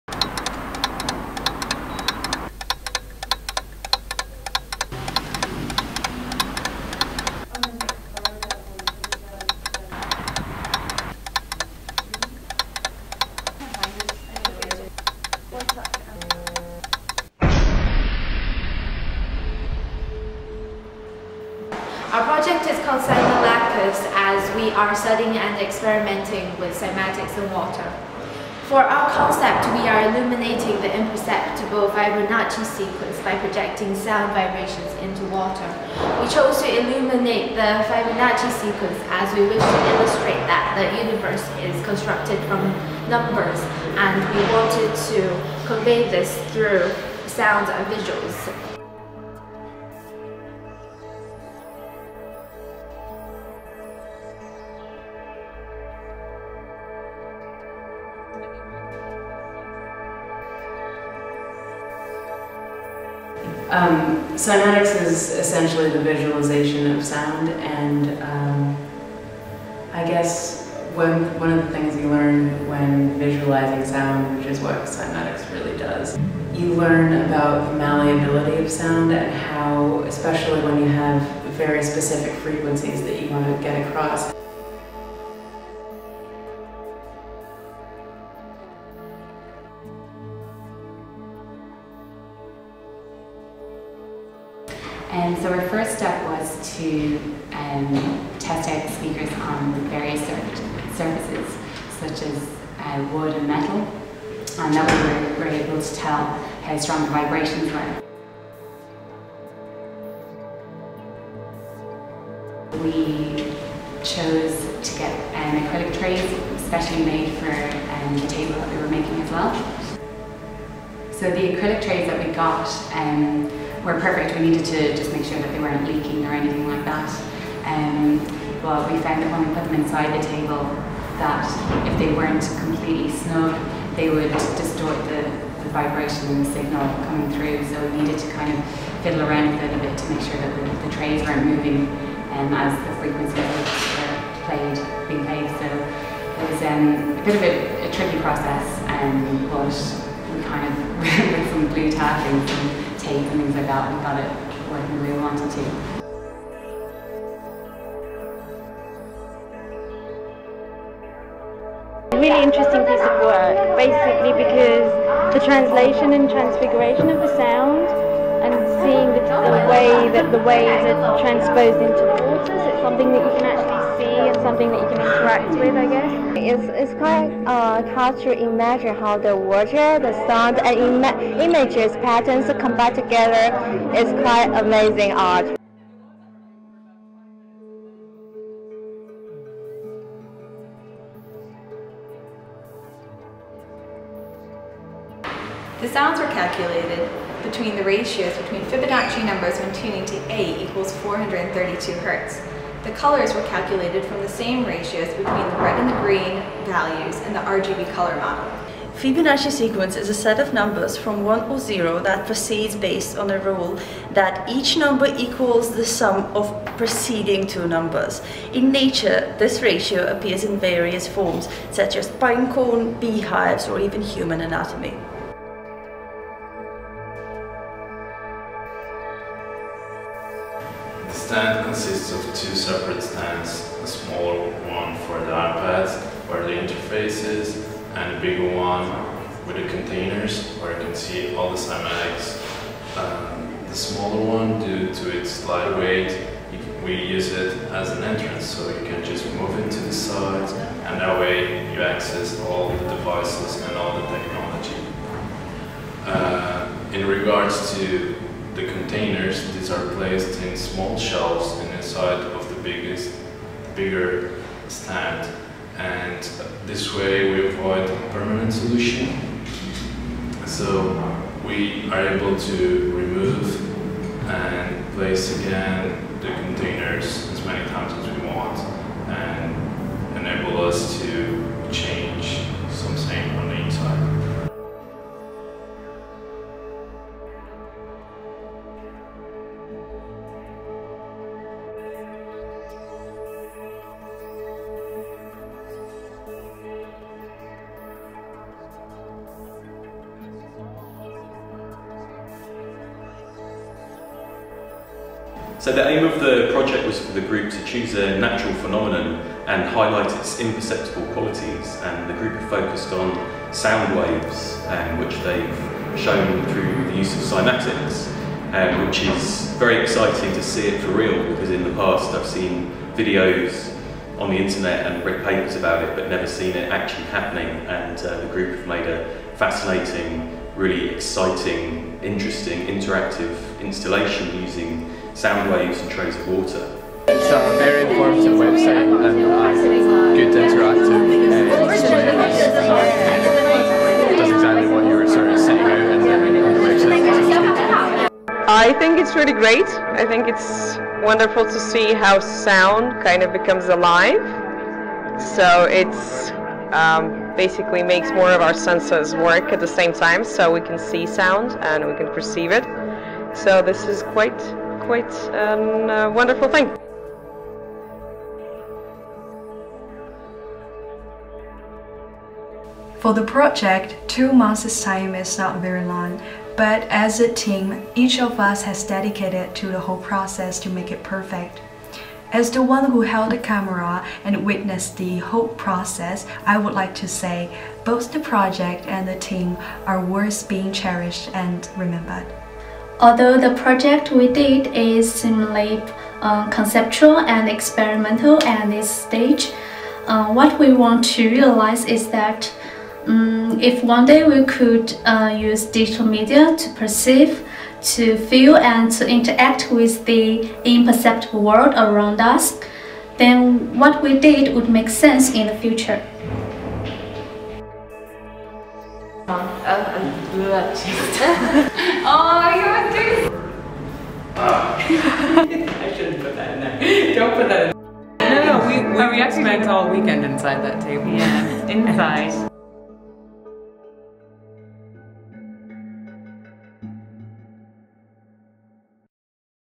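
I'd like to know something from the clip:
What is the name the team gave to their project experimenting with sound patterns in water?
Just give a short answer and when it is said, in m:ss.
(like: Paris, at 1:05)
Cymolacus, at 0:23.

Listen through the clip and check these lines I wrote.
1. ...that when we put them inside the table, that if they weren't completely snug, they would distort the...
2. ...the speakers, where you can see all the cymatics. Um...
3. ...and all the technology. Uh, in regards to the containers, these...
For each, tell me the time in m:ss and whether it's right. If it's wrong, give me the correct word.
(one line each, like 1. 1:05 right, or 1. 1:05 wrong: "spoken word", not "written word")
1. 2:09 right
2. 3:59 wrong: "containers", not "speakers"
3. 4:13 right.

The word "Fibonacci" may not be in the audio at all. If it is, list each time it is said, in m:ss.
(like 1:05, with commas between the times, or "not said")
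0:31, 0:37, 3:18, 3:28.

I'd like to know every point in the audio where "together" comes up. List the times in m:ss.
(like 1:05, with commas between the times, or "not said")
3:02.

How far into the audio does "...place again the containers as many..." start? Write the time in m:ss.
4:34.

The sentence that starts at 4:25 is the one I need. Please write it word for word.
And this way we avoid permanent solution.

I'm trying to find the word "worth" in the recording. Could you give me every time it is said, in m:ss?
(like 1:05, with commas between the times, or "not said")
6:30.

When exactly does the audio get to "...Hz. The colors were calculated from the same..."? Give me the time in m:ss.
3:21.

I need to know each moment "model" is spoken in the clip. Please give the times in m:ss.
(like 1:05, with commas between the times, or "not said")
3:28.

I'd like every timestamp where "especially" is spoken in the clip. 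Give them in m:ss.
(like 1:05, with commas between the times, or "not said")
1:20.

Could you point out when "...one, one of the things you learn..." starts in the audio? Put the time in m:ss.
1:10.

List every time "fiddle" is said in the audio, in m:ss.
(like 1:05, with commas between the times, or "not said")
2:19.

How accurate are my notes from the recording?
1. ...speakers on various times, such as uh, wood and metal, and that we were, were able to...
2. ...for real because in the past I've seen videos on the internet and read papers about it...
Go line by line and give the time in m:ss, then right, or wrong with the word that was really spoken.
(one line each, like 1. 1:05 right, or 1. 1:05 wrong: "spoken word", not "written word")
1. 1:38 wrong: "surfaces", not "times"
2. 5:20 right.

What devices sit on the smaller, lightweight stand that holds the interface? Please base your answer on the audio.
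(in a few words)
iPads.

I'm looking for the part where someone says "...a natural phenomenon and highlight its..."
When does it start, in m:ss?
5:07.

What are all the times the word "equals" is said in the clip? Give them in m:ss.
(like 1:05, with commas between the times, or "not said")
3:20, 3:35.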